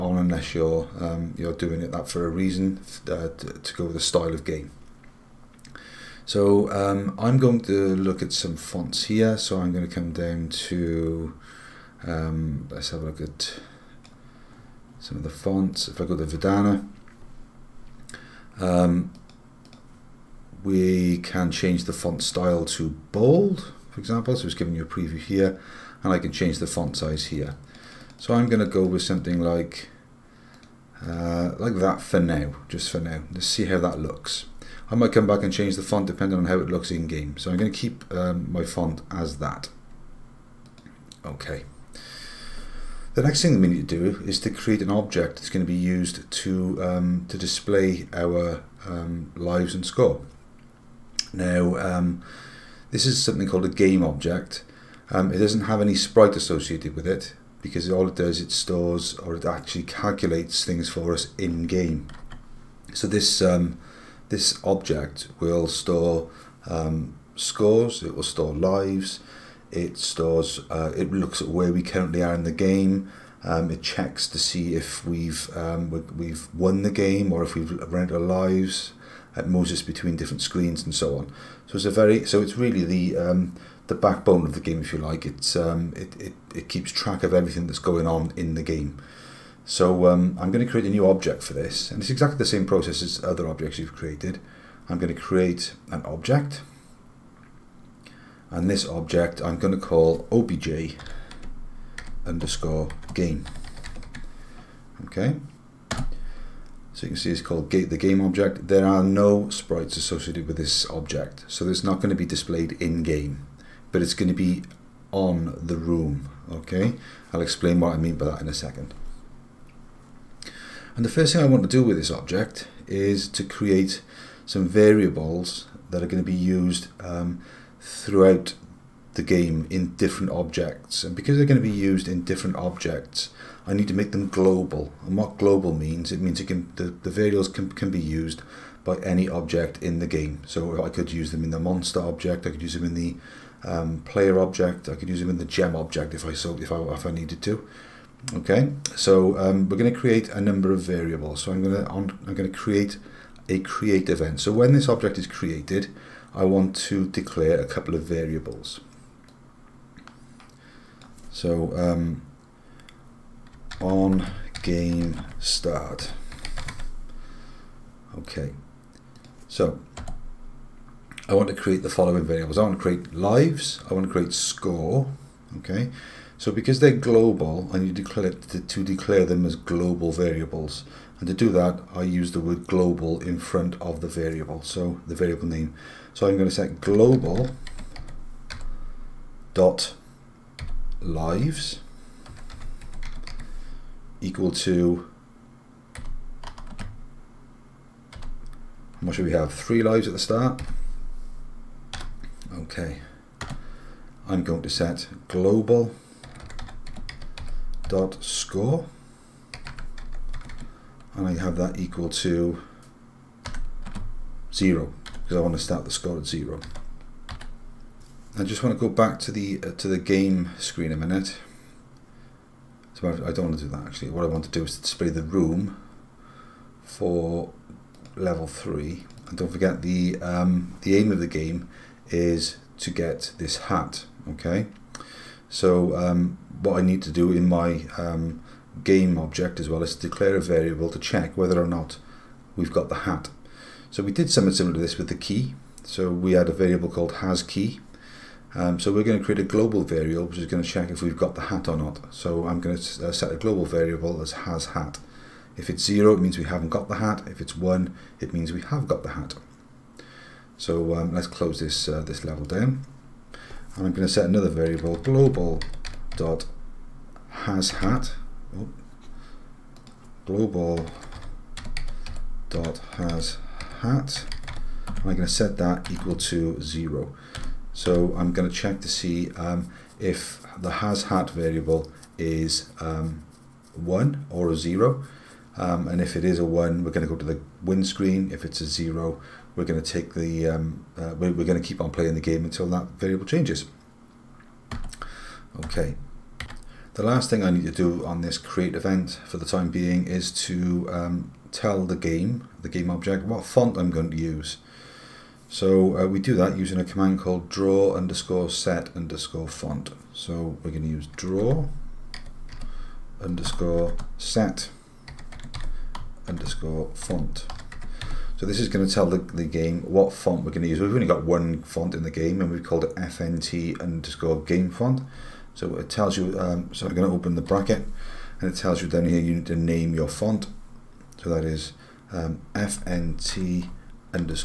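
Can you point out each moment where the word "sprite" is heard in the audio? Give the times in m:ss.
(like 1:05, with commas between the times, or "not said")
0:55, 1:49.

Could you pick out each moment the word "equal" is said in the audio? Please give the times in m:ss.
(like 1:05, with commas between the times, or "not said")
3:14, 3:31, 4:35.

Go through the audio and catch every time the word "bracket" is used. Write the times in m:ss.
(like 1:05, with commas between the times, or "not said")
5:27.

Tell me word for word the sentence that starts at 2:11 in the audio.
And because they're going to be used in different objects, I need to make them global.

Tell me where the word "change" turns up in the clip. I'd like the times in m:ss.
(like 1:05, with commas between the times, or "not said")
0:21, 0:26, 0:35, 4:53.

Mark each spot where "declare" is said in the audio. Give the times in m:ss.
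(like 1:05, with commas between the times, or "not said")
2:37, 2:58, 3:59.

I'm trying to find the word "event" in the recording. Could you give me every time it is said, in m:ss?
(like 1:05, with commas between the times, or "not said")
2:34, 4:58.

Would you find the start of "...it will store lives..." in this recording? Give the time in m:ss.
1:08.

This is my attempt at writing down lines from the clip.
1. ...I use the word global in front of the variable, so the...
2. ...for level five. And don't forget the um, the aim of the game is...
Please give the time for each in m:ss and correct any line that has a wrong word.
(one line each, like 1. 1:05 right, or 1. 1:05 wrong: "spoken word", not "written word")
1. 3:01 right
2. 3:46 wrong: "three", not "five".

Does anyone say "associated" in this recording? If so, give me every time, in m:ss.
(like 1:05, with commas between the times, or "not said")
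0:56, 1:49.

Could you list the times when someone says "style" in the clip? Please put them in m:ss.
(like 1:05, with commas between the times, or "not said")
0:04, 0:22.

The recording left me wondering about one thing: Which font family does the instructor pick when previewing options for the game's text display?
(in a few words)
Verdana.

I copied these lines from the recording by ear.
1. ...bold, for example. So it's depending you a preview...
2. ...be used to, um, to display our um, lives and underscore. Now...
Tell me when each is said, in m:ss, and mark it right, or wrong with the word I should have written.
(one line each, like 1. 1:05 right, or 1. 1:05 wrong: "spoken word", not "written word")
1. 0:23 wrong: "giving", not "depending"
2. 0:45 wrong: "score", not "underscore".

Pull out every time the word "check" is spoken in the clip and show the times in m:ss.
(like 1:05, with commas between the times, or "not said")
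1:13, 4:00, 4:10, 4:38.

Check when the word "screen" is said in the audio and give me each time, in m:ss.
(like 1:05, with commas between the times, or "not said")
1:20, 3:40, 4:47.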